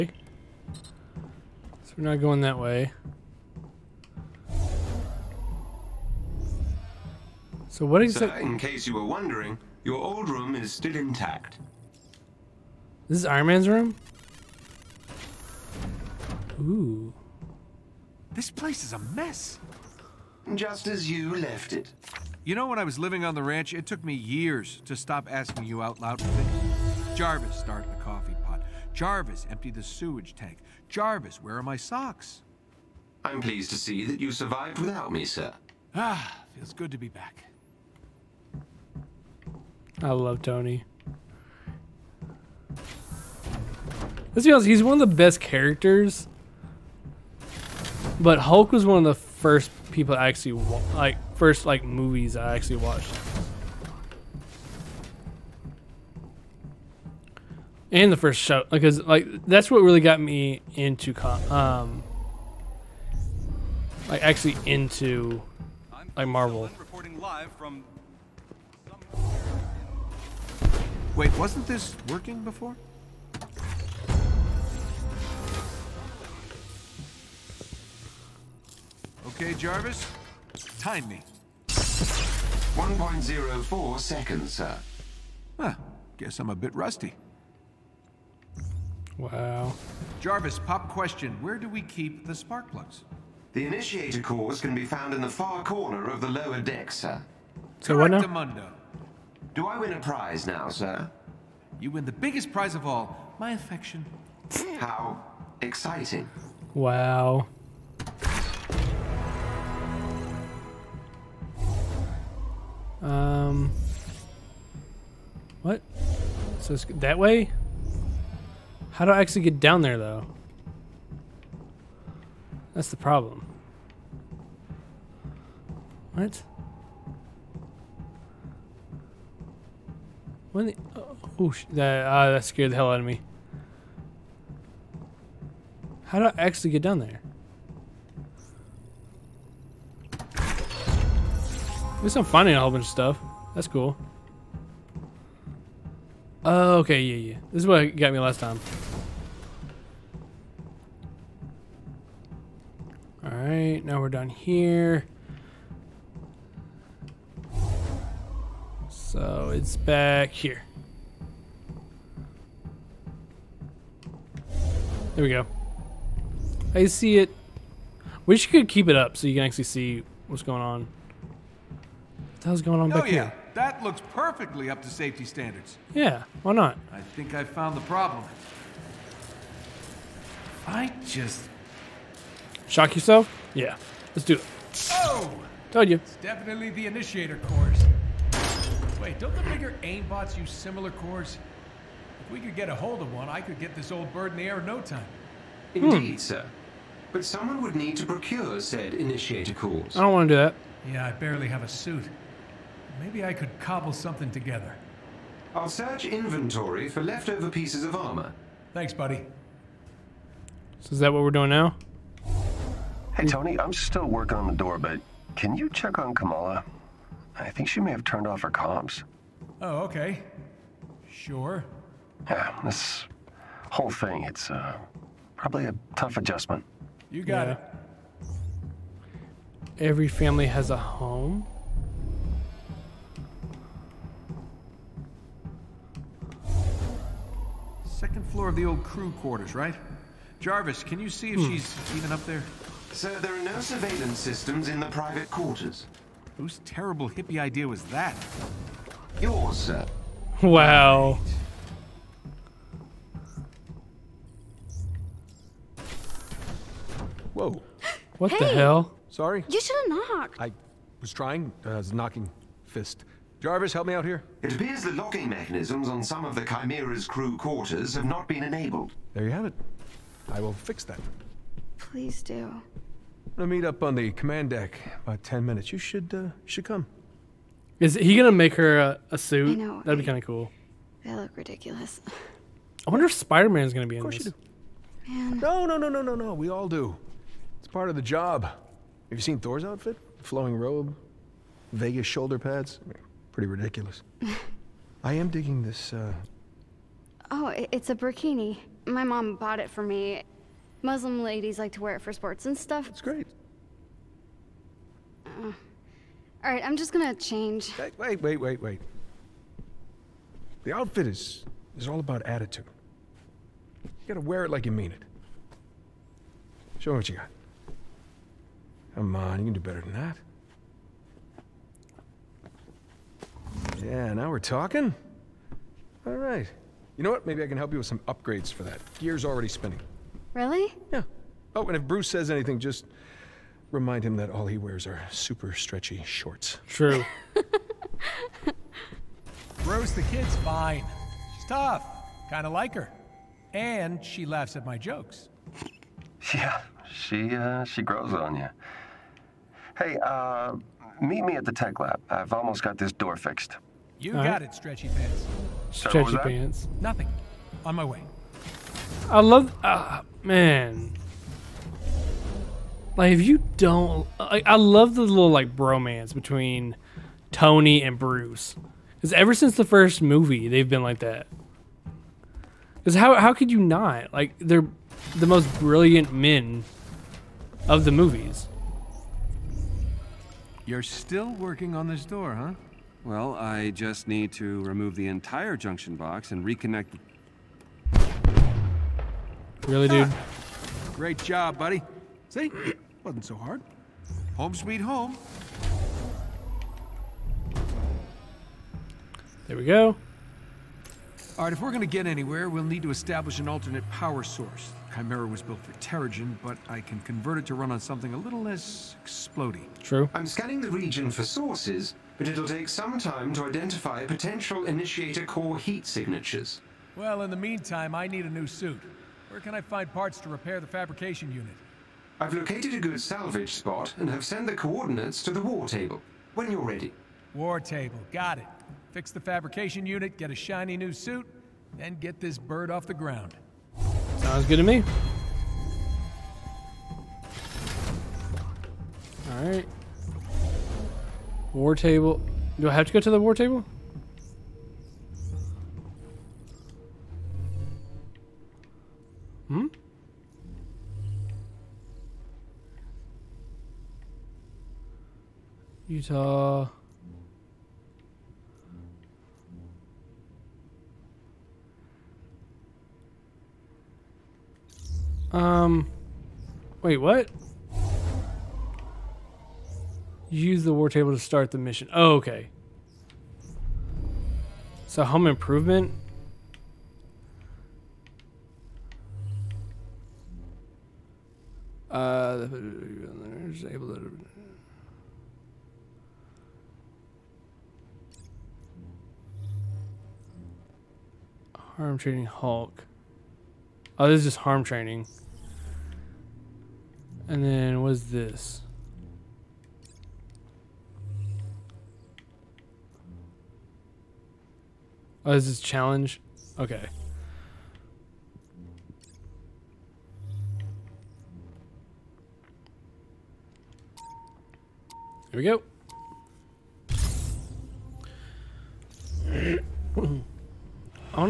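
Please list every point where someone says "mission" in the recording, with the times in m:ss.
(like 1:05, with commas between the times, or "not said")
7:51.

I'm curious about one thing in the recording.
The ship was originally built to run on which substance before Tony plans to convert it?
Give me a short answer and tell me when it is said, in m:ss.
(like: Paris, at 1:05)
Terrigen, at 6:45.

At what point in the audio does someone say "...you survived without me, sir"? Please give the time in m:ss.
0:34.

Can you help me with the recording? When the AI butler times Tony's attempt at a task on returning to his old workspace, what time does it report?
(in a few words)
1.04 seconds.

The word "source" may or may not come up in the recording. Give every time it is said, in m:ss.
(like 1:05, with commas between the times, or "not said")
6:44, 6:51.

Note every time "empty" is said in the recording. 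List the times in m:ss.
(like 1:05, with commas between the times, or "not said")
0:29.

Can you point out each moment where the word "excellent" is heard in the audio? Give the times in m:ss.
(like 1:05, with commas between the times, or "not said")
not said.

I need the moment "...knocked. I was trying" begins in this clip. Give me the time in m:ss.
4:19.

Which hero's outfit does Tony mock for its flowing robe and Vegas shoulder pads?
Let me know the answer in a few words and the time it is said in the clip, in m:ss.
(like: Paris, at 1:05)
Thor, at 4:49.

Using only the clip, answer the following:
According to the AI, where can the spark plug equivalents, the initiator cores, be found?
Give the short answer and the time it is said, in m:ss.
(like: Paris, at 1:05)
lower deck, at 1:35.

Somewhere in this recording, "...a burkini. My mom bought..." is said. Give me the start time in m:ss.
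4:57.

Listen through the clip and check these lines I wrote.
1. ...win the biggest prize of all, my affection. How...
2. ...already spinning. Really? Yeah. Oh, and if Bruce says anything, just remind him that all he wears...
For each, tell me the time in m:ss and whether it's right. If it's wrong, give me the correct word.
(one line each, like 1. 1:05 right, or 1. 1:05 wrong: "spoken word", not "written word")
1. 1:41 right
2. 5:29 right.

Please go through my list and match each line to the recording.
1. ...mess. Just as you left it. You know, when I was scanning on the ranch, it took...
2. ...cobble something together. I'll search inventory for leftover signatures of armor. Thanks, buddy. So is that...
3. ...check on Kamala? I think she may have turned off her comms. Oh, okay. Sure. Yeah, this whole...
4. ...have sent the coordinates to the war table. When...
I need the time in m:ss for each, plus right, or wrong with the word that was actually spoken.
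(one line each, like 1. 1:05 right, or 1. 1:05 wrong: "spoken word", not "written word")
1. 0:18 wrong: "living", not "scanning"
2. 3:23 wrong: "pieces", not "signatures"
3. 3:35 right
4. 7:04 right.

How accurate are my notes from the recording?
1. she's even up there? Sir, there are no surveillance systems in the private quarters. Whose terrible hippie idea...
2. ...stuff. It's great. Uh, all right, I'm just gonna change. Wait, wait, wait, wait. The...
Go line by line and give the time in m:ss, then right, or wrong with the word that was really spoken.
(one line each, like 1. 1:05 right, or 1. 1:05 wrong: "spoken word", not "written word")
1. 4:01 right
2. 5:02 right.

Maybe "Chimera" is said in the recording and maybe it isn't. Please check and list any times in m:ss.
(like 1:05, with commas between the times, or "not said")
4:26, 6:44.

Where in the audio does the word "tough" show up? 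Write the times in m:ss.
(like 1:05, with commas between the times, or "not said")
3:45, 5:41.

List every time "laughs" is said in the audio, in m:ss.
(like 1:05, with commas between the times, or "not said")
5:44.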